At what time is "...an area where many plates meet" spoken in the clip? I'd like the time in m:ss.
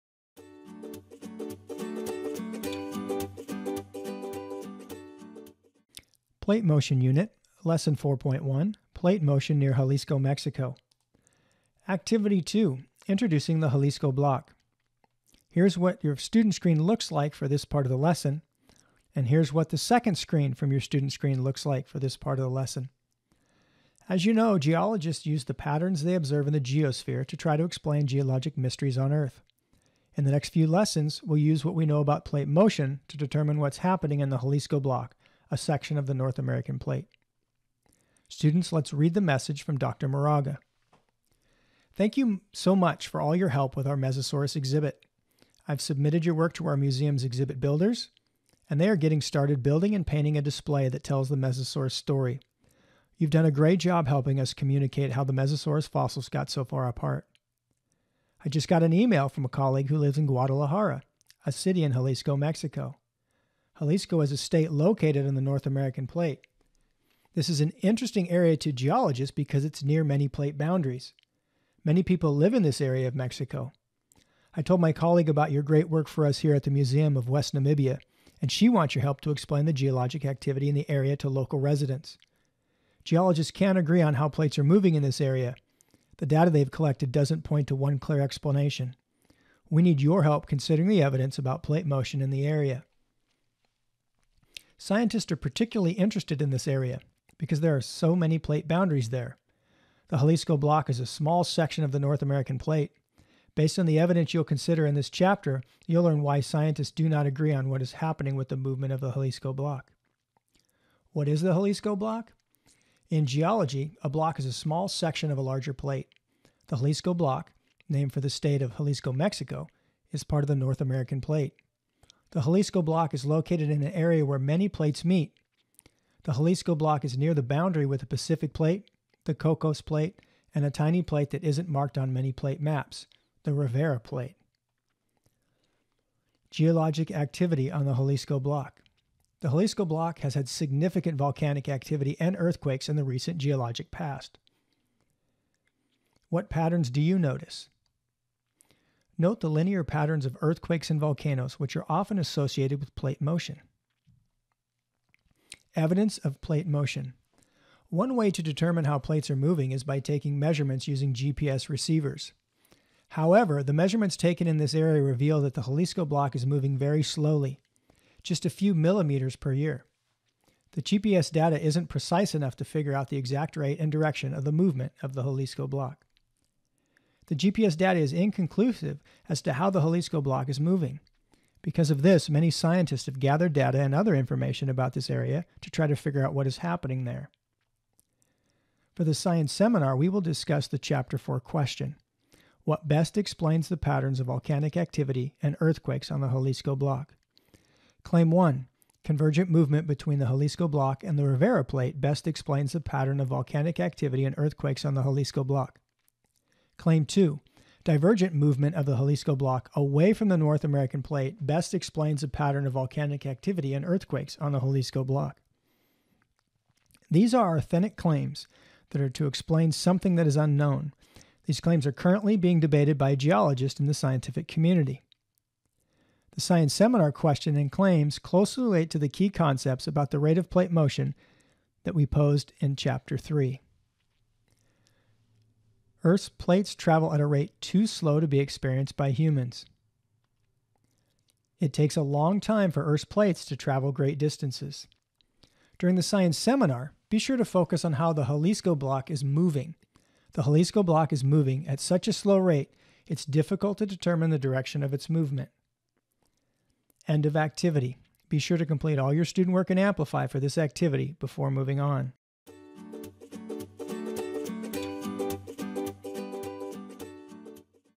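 2:03.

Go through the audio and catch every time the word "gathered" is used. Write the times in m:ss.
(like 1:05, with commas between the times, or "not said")
3:03.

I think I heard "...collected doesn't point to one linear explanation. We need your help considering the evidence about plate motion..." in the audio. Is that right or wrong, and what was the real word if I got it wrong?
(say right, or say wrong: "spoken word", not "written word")
wrong: "clear", not "linear".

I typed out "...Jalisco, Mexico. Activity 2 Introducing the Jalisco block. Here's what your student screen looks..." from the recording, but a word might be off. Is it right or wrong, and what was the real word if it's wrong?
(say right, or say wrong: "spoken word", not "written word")
right.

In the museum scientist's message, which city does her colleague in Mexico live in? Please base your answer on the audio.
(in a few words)
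Guadalajara.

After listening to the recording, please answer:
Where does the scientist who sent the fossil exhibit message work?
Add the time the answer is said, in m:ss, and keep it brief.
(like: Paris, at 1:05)
Museum of West Namibia, at 1:16.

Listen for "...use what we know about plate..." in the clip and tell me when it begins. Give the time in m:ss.
0:31.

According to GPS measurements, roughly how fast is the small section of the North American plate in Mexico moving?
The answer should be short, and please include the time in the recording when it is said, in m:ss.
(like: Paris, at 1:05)
a few millimeters per year, at 2:48.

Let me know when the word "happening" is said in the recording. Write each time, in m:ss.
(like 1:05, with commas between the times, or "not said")
0:33, 1:47, 3:06.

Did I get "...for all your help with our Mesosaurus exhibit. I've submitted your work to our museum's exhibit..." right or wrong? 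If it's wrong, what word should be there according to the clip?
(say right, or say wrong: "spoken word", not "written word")
right.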